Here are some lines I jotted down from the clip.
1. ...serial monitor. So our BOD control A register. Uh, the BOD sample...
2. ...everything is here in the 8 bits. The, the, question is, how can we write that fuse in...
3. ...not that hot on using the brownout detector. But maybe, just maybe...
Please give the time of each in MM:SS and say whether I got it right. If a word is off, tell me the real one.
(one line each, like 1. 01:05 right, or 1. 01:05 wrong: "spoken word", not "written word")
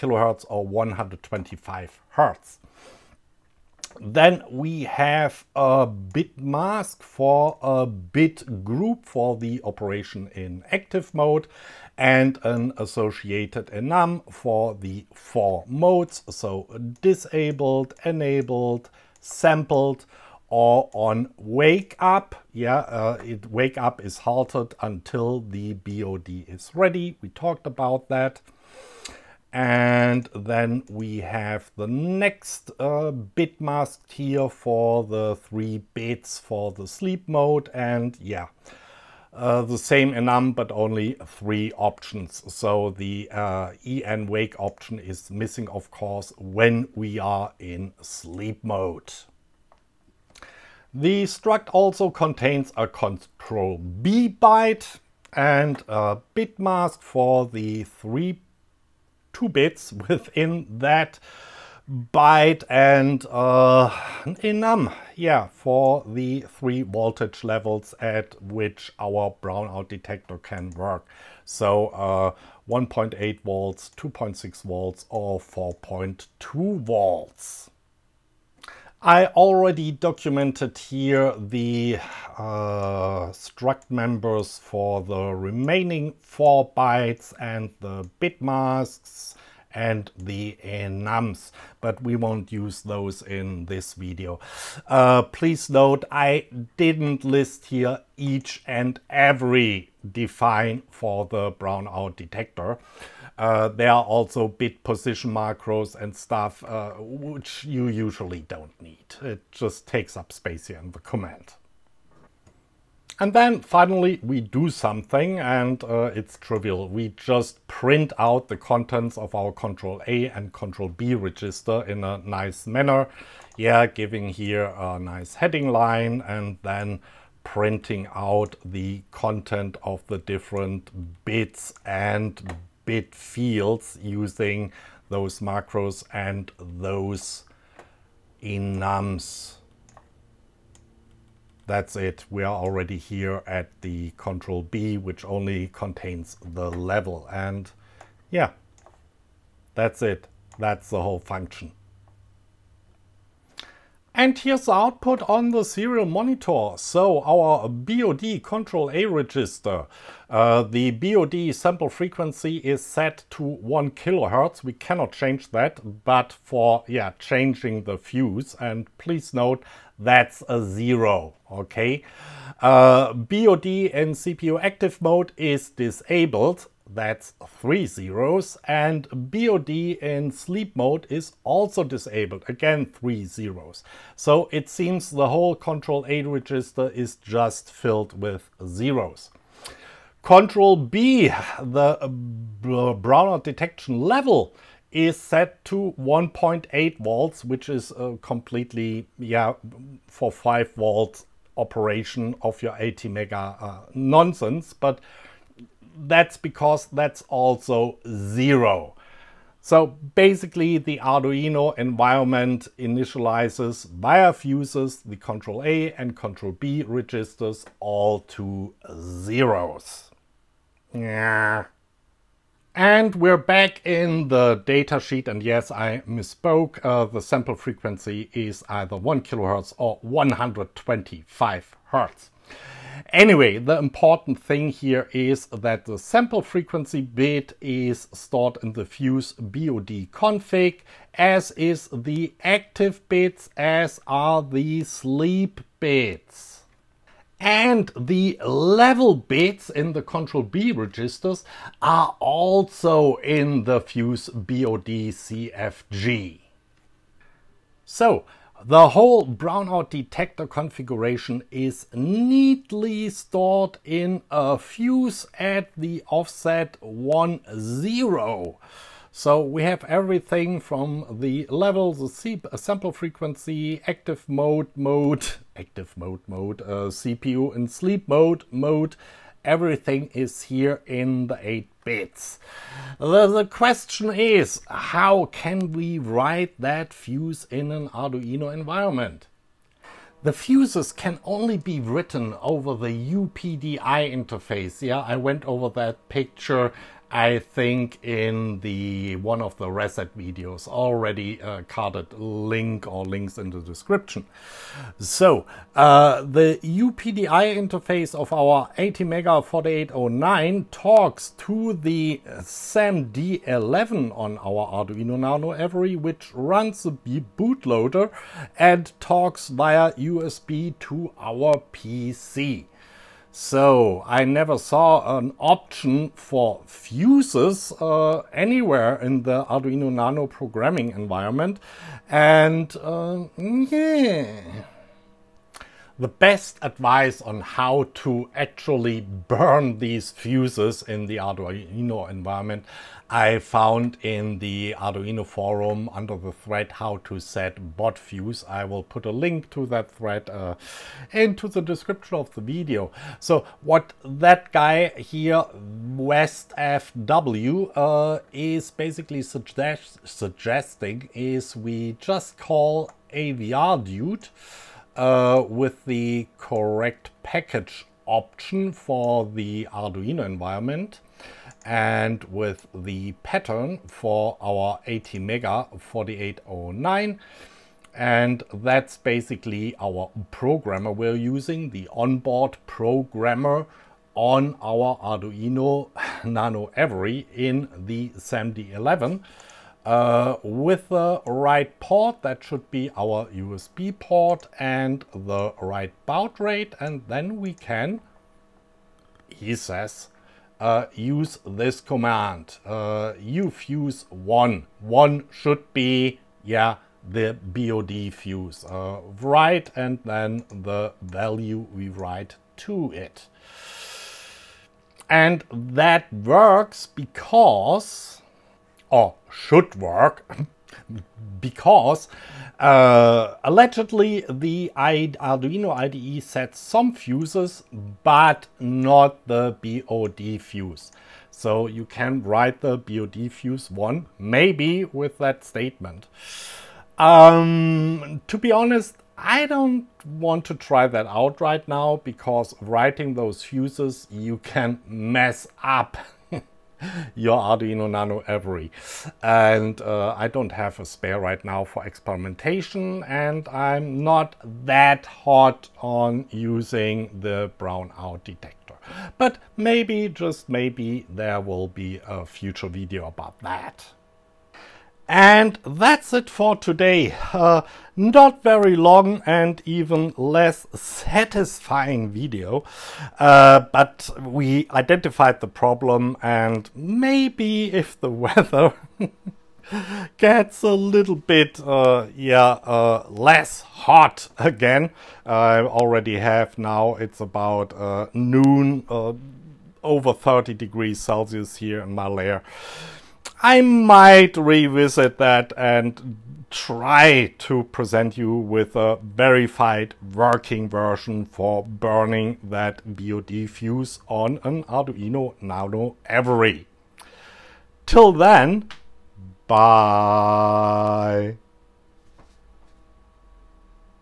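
1. 02:35 right
2. 04:39 right
3. 07:34 right.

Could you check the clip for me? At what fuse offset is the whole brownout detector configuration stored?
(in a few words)
10.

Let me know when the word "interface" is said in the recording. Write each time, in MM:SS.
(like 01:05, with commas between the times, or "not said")
04:53, 05:07.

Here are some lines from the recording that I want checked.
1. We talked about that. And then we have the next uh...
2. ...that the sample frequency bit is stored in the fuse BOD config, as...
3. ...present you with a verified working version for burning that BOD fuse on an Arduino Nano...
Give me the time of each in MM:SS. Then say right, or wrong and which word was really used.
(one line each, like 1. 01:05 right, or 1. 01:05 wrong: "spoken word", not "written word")
1. 00:27 right
2. 03:55 right
3. 08:17 right.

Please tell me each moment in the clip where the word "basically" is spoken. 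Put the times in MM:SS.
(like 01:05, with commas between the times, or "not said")
03:30, 05:58, 06:18.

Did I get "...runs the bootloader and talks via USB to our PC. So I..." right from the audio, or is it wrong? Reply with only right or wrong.
right.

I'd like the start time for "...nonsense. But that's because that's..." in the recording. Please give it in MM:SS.
03:23.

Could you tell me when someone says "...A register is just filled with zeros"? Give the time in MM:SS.
03:06.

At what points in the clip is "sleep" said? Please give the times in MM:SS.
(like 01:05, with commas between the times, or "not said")
00:36, 00:47, 03:00, 04:04, 04:37.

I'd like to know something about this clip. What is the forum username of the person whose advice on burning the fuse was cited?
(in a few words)
Westfw.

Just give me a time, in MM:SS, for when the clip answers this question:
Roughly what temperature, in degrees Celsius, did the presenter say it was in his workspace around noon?
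08:09.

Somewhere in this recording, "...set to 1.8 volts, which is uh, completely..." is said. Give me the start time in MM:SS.
03:15.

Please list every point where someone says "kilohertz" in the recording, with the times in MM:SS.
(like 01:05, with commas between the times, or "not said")
02:43, 03:49.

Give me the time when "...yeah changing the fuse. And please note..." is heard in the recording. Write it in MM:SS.
02:46.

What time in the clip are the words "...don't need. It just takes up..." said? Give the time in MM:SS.
01:48.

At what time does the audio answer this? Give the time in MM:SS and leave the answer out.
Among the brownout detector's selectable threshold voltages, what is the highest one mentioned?
01:15.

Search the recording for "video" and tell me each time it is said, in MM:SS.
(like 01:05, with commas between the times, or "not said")
01:33, 05:00, 05:52, 07:42, 07:52.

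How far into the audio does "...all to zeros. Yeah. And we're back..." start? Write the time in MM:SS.
03:37.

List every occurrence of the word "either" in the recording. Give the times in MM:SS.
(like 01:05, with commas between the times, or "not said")
03:48.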